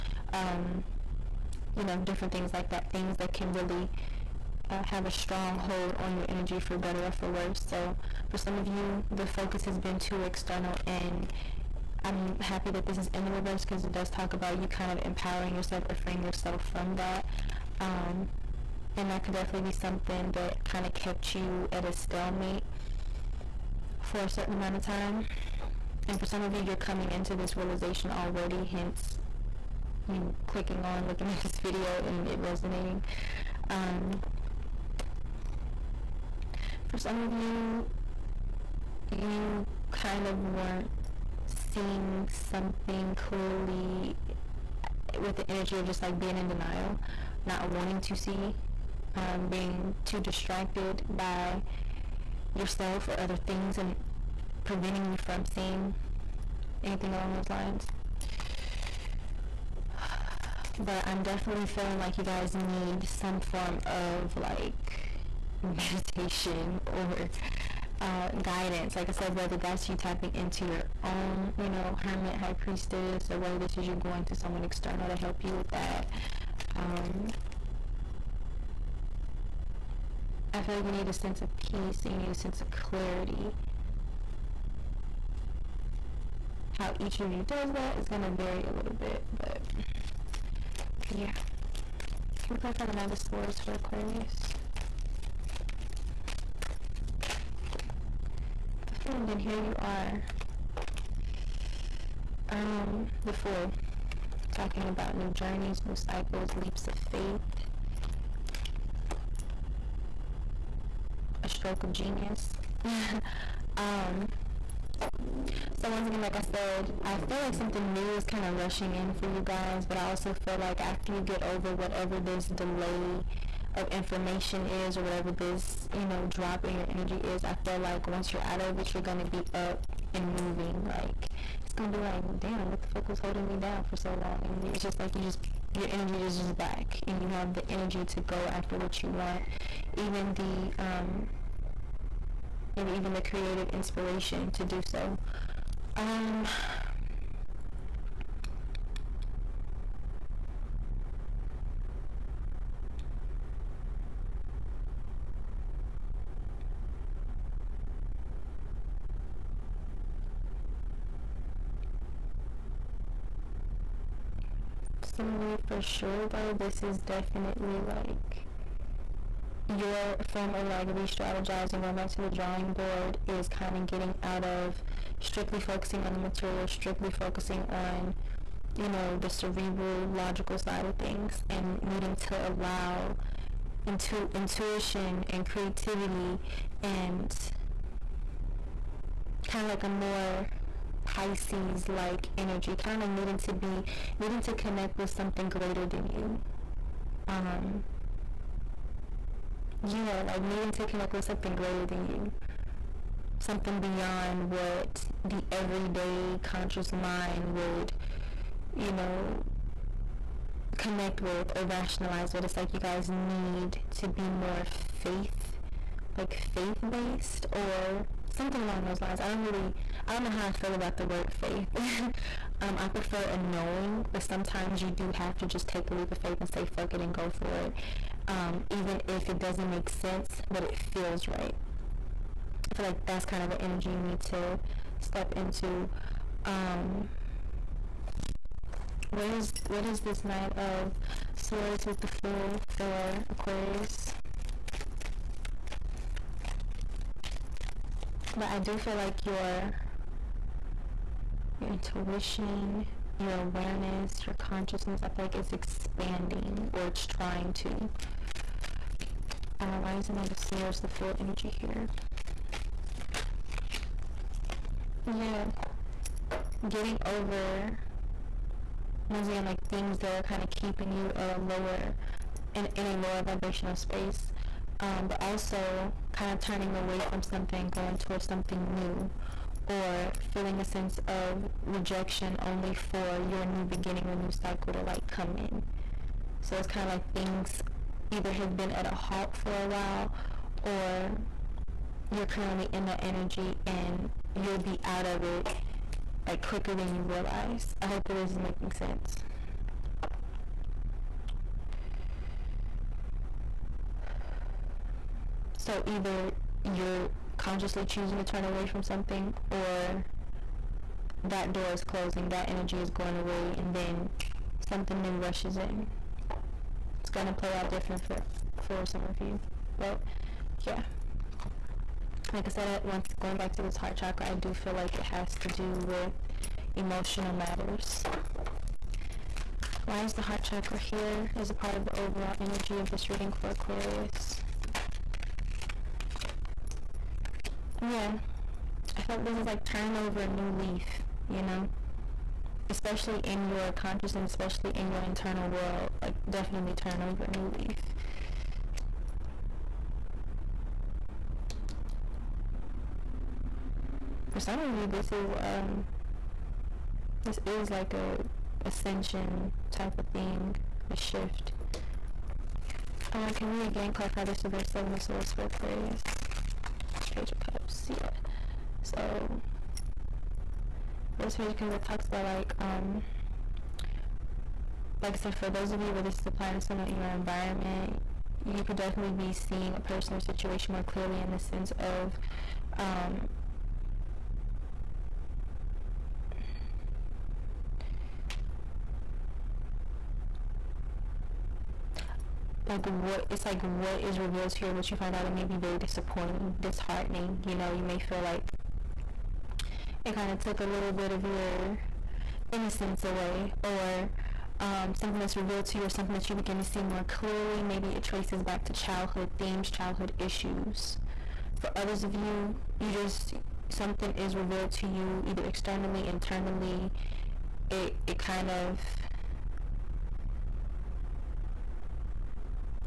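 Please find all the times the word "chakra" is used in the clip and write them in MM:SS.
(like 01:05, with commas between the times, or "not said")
05:23, 05:30.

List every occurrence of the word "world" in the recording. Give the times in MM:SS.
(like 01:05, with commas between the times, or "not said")
05:45.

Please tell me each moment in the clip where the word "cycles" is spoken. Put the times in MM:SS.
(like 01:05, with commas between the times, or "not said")
01:45, 04:44.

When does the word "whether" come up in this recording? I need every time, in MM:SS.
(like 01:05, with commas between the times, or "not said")
01:09, 01:13.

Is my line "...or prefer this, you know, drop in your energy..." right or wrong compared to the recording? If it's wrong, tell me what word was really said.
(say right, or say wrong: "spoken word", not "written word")
wrong: "whatever", not "prefer".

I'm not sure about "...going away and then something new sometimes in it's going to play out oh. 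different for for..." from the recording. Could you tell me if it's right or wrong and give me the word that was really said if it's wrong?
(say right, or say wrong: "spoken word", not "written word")
wrong: "rushes", not "sometimes".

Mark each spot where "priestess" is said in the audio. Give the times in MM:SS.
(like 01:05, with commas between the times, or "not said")
01:12.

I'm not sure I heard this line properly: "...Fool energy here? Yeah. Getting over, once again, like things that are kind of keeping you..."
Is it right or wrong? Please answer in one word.
right.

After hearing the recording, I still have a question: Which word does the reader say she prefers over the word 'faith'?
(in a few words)
knowing.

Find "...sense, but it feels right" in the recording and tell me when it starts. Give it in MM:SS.
03:49.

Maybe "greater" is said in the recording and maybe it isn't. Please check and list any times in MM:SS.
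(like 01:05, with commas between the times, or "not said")
03:15, 03:21.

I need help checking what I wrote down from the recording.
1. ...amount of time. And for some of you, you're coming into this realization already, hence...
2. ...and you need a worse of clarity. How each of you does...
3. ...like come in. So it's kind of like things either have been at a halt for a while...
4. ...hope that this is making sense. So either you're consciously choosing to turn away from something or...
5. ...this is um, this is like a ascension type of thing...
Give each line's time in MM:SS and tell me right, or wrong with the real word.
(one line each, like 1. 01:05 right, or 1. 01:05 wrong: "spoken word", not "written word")
1. 00:24 right
2. 01:22 wrong: "sense", not "worse"
3. 04:44 right
4. 04:57 right
5. 05:54 right.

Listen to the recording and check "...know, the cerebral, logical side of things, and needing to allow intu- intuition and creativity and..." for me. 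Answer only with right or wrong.
right.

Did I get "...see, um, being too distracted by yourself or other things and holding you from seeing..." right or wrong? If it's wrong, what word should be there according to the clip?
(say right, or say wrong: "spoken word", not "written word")
wrong: "preventing", not "holding".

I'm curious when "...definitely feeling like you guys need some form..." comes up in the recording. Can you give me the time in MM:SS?
01:01.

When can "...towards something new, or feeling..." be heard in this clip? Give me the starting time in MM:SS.
04:37.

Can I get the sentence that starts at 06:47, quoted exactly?
Maybe it traces back to childhood themes, childhood issues.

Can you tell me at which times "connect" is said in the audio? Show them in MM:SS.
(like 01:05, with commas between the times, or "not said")
03:14, 03:20, 03:30.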